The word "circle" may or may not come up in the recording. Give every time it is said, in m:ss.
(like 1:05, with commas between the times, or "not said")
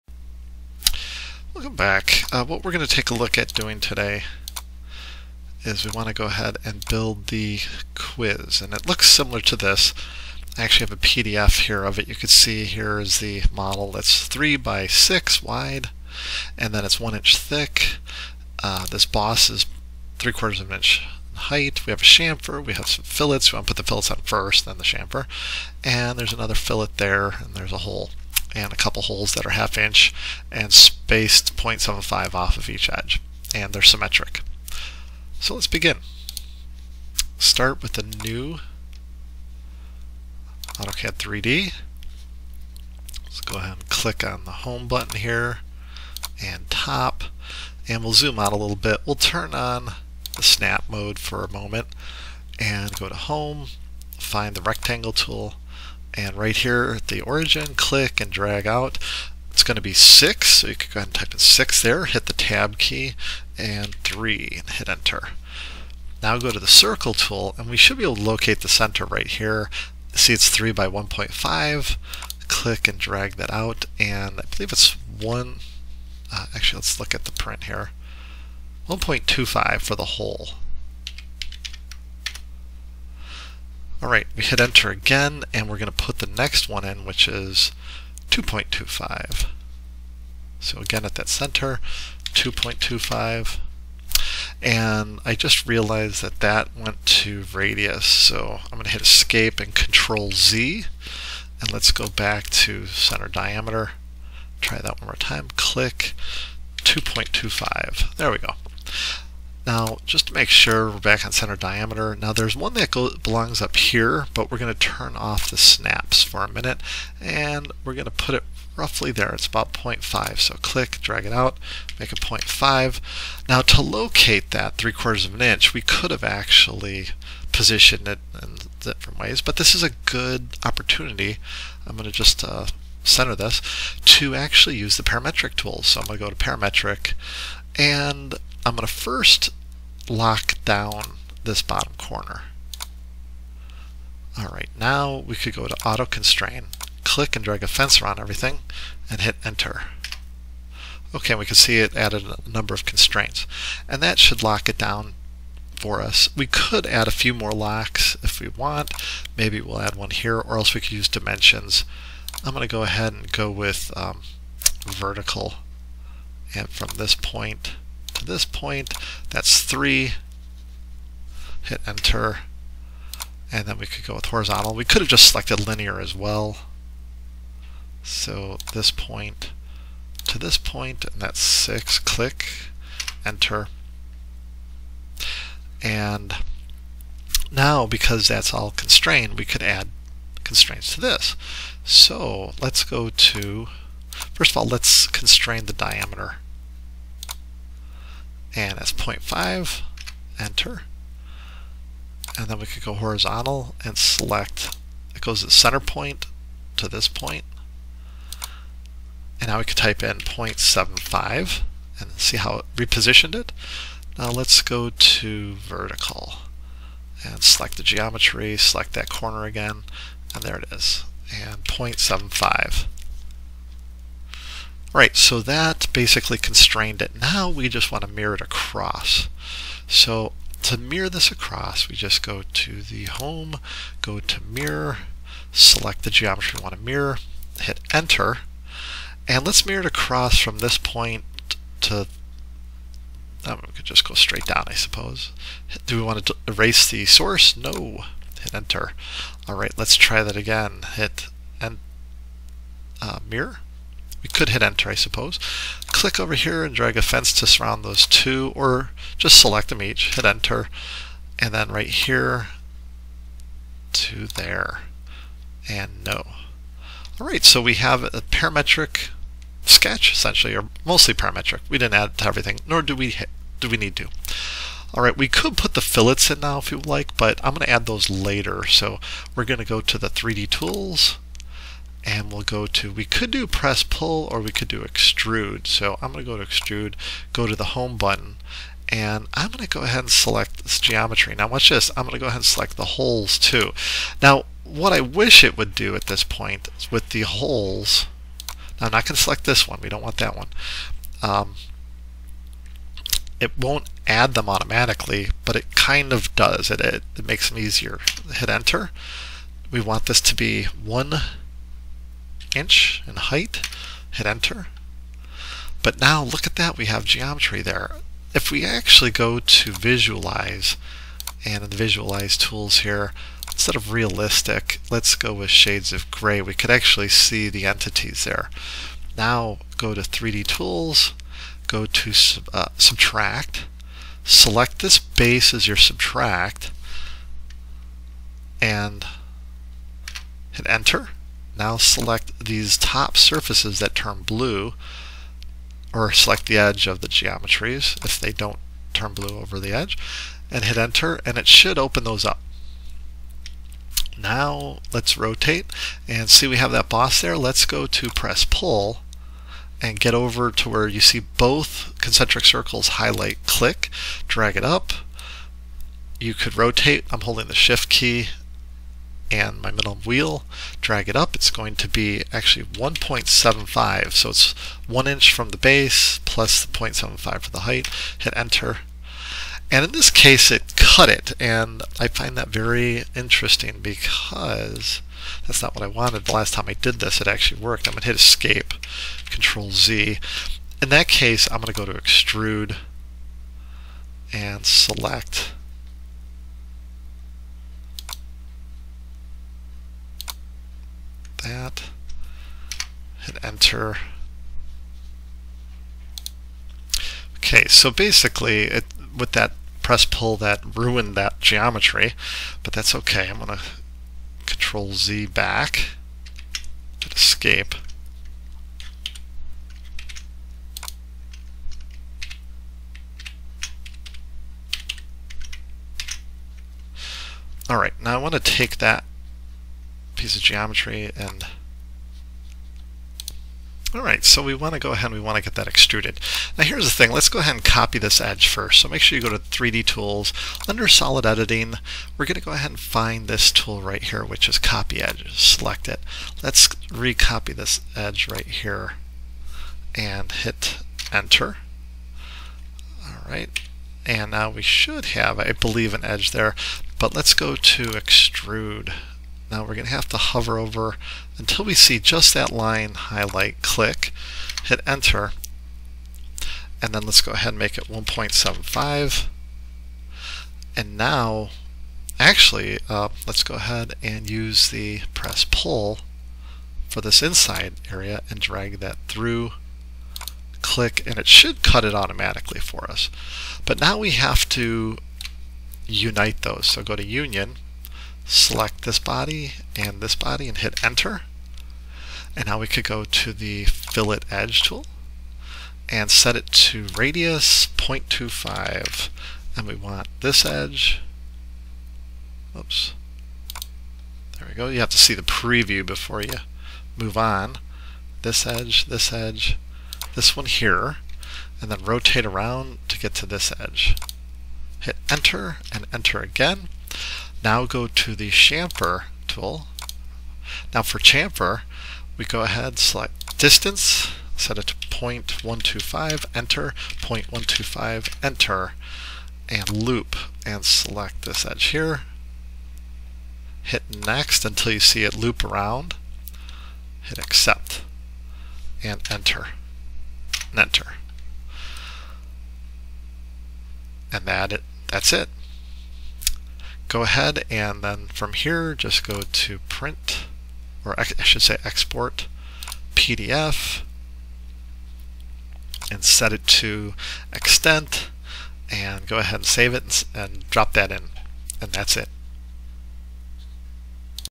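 1:06, 6:02.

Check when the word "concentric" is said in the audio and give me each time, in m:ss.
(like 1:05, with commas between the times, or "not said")
6:02.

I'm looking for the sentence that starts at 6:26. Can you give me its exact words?
The last time I did this it actually worked.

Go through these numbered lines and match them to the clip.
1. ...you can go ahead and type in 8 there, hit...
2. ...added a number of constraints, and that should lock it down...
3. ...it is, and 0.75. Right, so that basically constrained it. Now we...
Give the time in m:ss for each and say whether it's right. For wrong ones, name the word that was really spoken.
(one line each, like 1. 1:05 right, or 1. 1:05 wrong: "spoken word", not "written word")
1. 1:00 wrong: "6", not "8"
2. 2:31 right
3. 3:40 right.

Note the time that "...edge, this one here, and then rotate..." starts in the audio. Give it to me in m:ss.
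8:29.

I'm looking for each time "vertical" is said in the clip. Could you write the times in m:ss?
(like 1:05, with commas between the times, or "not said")
2:44, 3:35.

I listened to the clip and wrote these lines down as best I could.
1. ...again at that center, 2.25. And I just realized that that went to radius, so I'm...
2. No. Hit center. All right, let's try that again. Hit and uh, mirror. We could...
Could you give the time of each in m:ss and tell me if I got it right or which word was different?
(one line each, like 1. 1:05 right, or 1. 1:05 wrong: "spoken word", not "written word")
1. 1:30 right
2. 4:07 wrong: "enter", not "center".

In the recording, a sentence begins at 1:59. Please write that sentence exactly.
It's about 0.5, so click, drag it out, make it 0.5.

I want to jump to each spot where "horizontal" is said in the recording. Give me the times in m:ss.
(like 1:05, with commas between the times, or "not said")
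2:54, 3:22.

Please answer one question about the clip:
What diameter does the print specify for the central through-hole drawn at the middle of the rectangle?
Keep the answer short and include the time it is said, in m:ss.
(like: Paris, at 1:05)
1.25, at 1:18.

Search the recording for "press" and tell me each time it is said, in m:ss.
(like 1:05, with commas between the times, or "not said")
4:43, 5:58, 6:49, 7:55.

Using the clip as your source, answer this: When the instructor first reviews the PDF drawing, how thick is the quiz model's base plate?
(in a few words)
1 inch.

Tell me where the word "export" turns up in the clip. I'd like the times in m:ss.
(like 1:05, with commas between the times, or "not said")
9:11.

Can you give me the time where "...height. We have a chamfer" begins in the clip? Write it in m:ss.
0:21.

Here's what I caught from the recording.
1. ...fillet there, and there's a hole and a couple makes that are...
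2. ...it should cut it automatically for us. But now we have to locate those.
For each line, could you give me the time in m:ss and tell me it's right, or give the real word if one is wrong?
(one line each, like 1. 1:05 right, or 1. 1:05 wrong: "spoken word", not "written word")
1. 0:26 wrong: "holes", not "makes"
2. 8:01 wrong: "unite", not "locate".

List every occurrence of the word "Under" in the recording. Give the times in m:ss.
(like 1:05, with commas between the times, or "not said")
7:20.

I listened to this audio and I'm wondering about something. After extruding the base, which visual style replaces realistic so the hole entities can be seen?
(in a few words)
shades of gray.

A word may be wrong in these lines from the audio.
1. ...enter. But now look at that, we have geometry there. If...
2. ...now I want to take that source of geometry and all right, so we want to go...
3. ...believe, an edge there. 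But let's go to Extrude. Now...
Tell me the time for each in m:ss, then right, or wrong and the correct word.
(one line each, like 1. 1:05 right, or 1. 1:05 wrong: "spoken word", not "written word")
1. 5:14 right
2. 7:08 wrong: "piece", not "source"
3. 7:35 right.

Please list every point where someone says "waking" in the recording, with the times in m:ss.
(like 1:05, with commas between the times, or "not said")
not said.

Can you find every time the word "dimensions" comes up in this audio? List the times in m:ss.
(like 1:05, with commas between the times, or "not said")
2:41.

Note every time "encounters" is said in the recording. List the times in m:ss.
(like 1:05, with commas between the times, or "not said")
not said.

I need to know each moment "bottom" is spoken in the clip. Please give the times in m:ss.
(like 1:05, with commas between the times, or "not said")
2:21.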